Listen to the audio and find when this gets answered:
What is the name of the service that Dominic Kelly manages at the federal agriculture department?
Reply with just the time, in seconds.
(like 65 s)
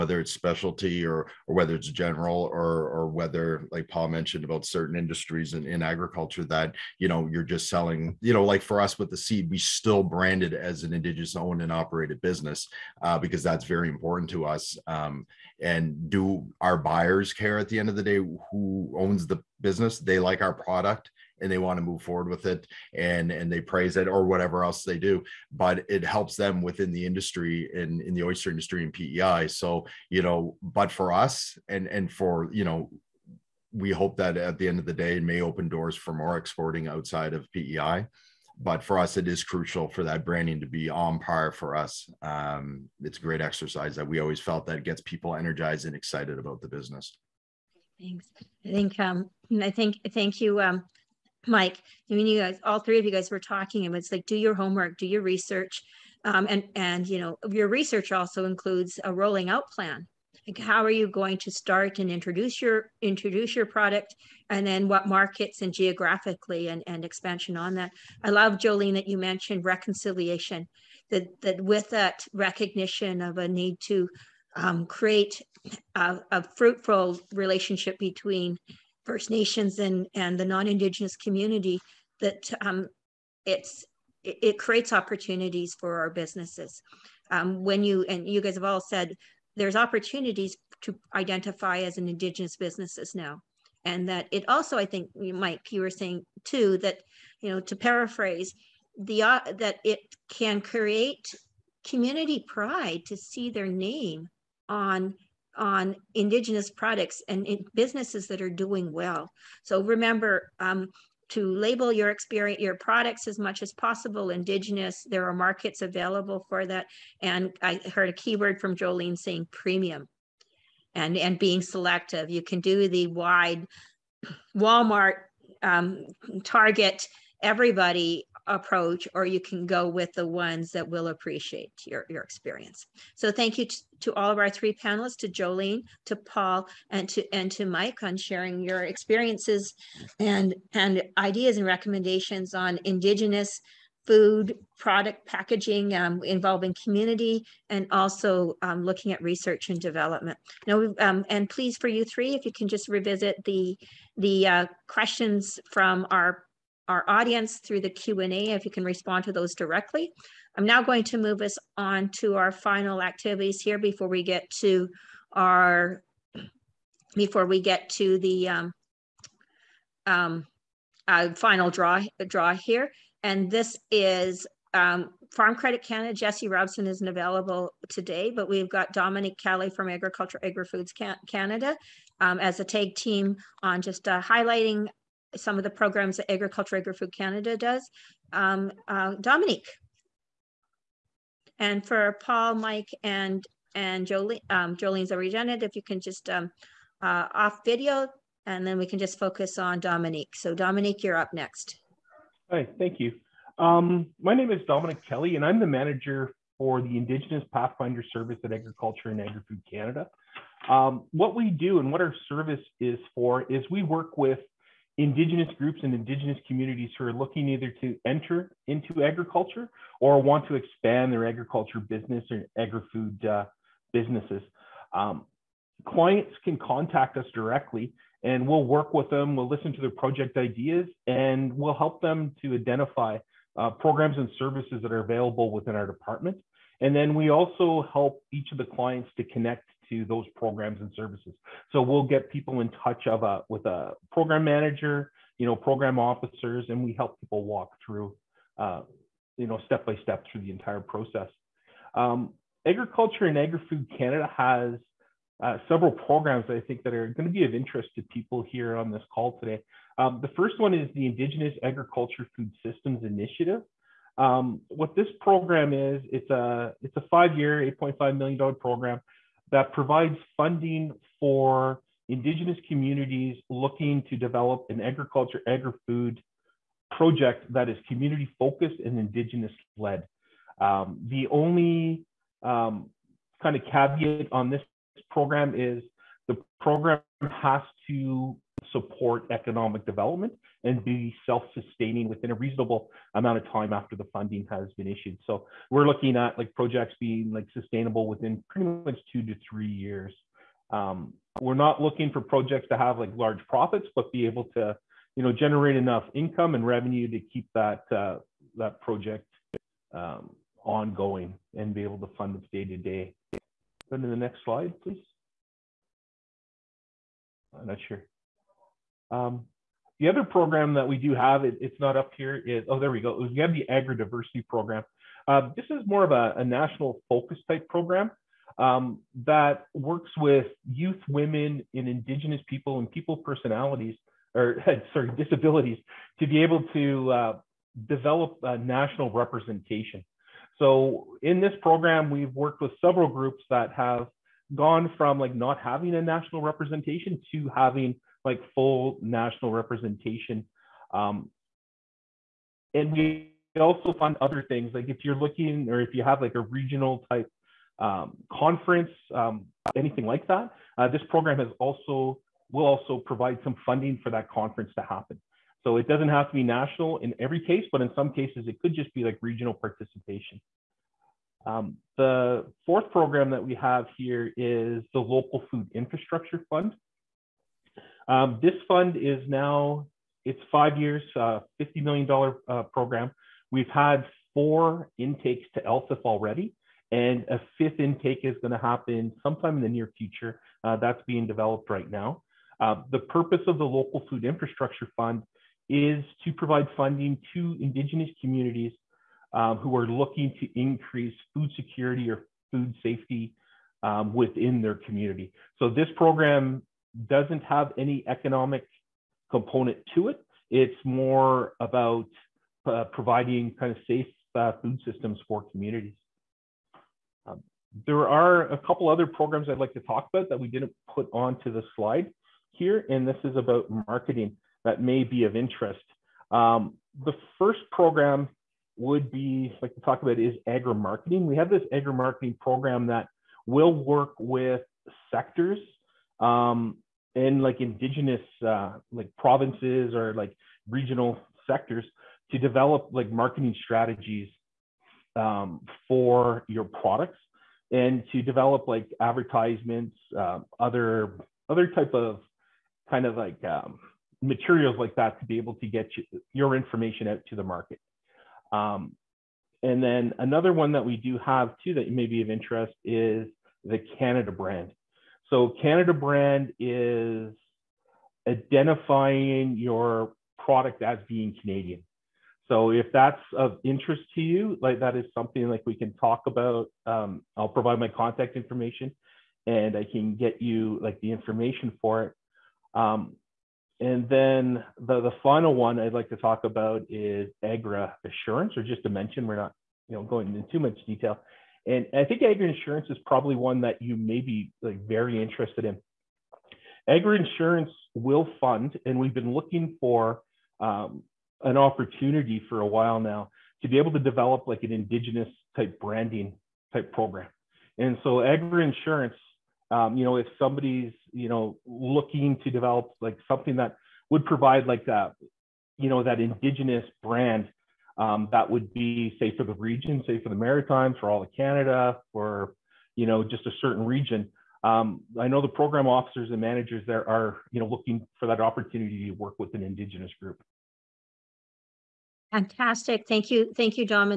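206 s.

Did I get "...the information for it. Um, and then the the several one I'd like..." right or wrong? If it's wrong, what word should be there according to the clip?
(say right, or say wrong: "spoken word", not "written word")
wrong: "final", not "several".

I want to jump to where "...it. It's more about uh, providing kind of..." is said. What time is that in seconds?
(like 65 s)
410 s.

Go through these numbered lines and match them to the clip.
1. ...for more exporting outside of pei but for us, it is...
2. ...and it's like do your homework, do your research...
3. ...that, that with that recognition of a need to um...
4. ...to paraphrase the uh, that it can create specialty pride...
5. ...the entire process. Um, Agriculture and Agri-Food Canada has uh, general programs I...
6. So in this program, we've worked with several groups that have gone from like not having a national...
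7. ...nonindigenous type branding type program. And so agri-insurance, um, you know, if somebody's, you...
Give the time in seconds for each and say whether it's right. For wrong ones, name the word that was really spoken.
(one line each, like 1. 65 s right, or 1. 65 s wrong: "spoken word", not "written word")
1. 35 s right
2. 53 s right
3. 71 s right
4. 97 s wrong: "community", not "specialty"
5. 250 s wrong: "several", not "general"
6. 340 s right
7. 504 s wrong: "indigenous", not "nonindigenous".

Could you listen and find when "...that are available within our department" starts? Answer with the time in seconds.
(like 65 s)
234 s.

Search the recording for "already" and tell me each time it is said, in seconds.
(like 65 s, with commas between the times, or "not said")
195 s, 386 s.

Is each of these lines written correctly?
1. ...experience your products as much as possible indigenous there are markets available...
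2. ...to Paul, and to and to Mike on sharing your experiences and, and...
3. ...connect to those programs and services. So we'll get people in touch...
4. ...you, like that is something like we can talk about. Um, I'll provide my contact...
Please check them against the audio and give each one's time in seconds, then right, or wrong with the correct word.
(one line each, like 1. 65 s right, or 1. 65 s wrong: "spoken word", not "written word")
1. 112 s right
2. 136 s right
3. 239 s right
4. 474 s right.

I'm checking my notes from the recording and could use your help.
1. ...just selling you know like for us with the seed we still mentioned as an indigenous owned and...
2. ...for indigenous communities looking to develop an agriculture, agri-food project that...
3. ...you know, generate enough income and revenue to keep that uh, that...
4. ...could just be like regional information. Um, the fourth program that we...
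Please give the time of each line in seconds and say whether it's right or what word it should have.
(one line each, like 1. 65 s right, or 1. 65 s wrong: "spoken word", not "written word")
1. 7 s wrong: "branded", not "mentioned"
2. 271 s right
3. 305 s right
4. 368 s wrong: "participation", not "information".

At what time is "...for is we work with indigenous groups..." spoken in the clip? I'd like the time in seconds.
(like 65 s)
213 s.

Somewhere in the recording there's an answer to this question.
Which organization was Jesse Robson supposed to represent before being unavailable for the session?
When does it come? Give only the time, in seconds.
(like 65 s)
175 s.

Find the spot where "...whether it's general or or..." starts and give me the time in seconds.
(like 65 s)
1 s.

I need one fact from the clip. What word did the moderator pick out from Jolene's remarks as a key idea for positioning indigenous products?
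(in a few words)
premium.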